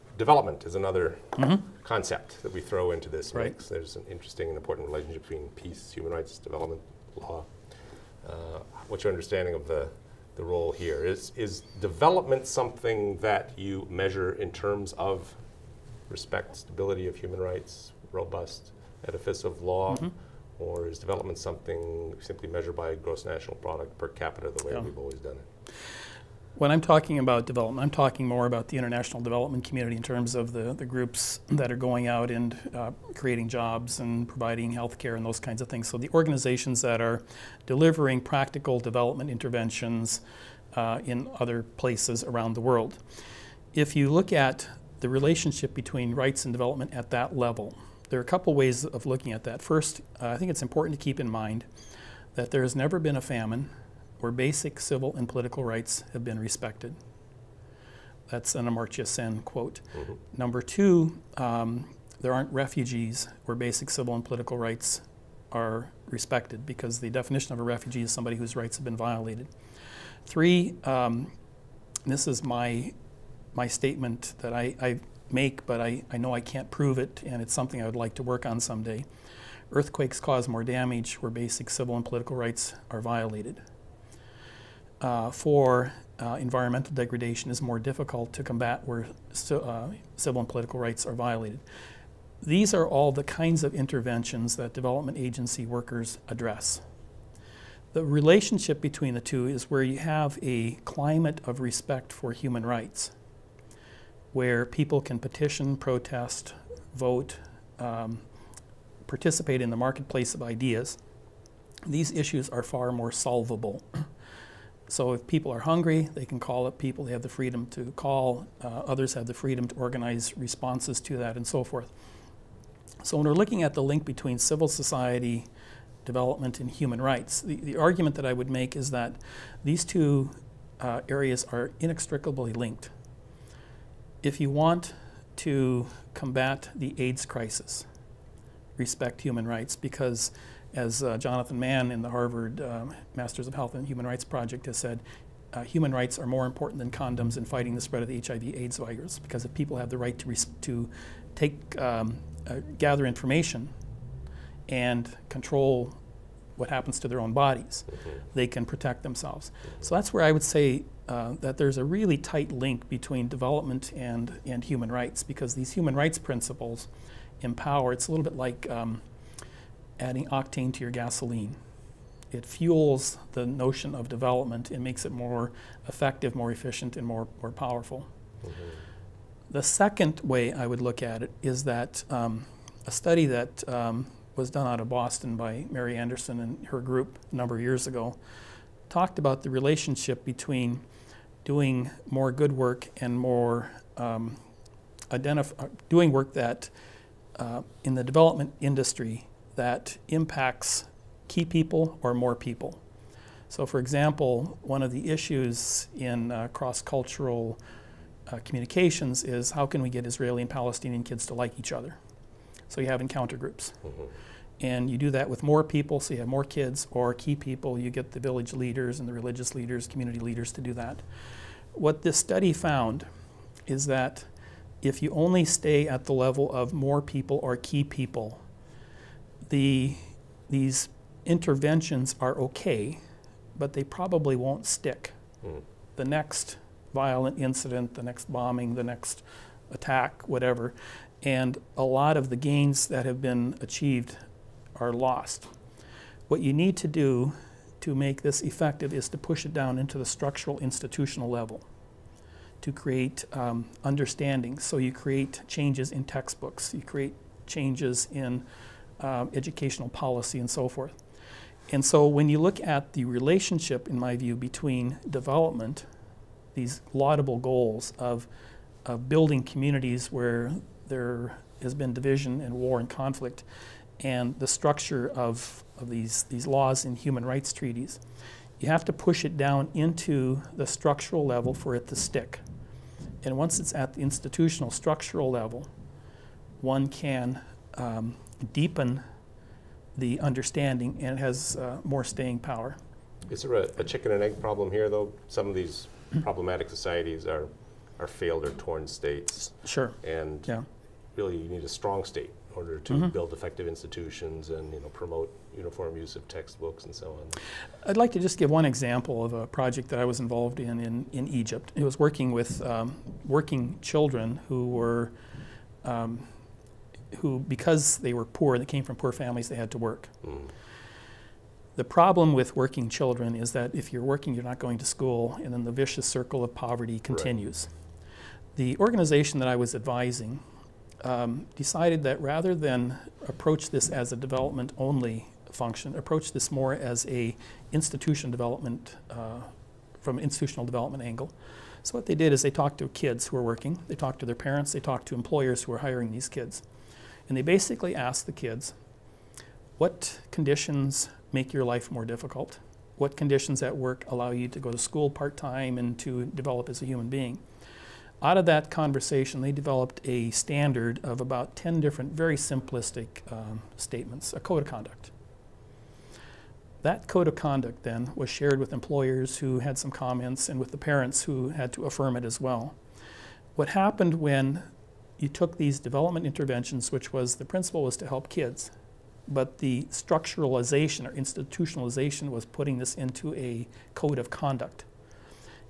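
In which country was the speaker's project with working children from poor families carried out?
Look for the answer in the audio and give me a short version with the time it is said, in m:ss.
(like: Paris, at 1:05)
Egypt, at 5:11.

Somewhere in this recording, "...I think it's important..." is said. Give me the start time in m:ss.
0:50.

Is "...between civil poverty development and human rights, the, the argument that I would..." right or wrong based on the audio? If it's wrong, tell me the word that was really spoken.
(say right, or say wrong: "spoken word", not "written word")
wrong: "society", not "poverty".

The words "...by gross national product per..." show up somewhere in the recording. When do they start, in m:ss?
0:22.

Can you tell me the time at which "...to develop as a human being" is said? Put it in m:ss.
5:55.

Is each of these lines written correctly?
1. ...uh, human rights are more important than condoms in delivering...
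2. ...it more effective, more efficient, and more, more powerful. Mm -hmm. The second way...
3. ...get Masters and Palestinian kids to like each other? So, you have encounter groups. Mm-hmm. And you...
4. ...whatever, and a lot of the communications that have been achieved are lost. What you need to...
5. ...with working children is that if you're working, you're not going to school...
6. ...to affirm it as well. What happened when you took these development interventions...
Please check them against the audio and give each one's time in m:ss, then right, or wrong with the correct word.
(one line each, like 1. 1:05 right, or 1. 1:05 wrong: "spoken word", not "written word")
1. 2:25 wrong: "fighting", not "delivering"
2. 2:55 right
3. 3:29 wrong: "Israeli", not "Masters"
4. 4:00 wrong: "gains", not "communications"
5. 5:22 right
6. 6:11 right.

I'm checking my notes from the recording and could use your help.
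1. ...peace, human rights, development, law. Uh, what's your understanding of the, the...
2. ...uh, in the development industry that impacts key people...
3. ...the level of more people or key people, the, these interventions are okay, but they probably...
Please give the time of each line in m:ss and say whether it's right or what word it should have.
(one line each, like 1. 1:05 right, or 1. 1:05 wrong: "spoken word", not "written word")
1. 0:05 right
2. 3:17 right
3. 3:46 right.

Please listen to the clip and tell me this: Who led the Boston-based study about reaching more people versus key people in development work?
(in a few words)
Mary Anderson.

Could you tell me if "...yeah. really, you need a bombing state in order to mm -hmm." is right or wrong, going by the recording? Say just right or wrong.
wrong.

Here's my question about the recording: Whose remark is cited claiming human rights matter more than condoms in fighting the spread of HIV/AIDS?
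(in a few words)
Jonathan Mann.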